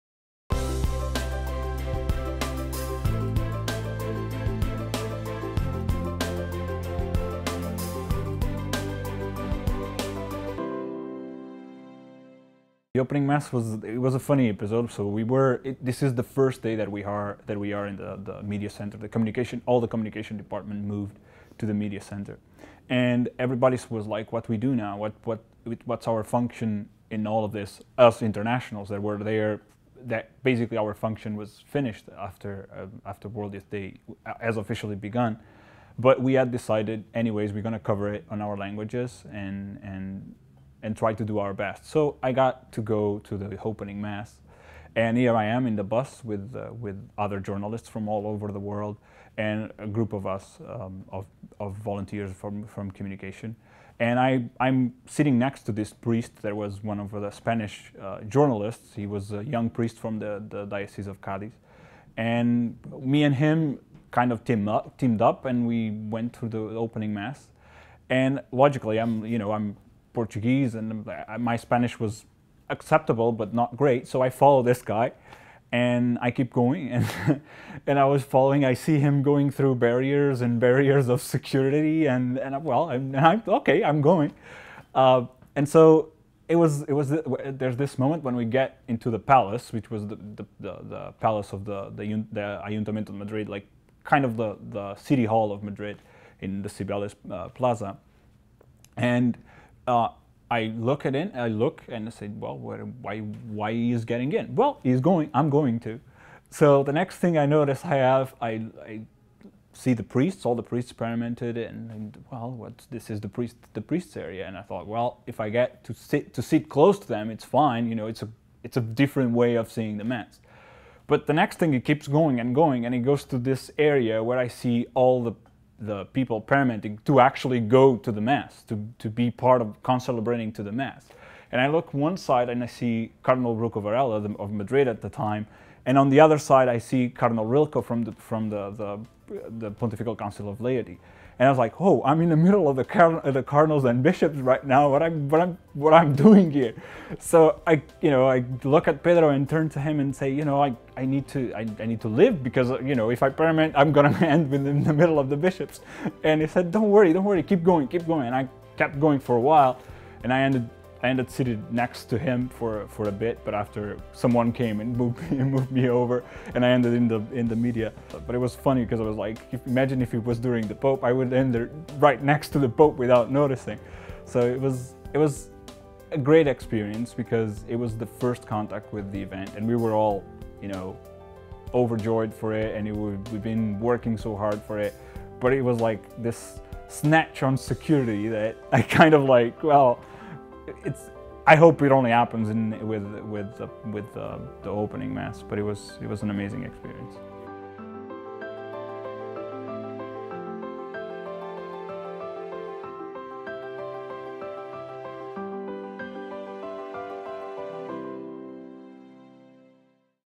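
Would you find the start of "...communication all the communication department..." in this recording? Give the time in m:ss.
0:19.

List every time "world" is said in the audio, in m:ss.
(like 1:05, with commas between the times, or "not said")
0:33, 0:48.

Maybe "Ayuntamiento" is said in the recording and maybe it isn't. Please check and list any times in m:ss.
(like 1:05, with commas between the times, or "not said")
1:32.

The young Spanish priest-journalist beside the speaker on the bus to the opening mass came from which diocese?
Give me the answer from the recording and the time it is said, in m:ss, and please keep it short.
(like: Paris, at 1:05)
Cadiz, at 1:00.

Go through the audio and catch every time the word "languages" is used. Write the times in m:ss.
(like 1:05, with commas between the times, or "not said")
0:38.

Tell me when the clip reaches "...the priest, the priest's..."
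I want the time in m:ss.
1:53.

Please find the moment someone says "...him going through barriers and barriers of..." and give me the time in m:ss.
1:18.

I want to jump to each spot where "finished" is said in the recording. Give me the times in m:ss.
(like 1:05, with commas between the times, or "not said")
0:31.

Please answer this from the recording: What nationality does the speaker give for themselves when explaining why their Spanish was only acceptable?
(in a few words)
Portuguese.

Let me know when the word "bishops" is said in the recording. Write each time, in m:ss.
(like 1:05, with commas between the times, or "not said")
2:24, 2:35.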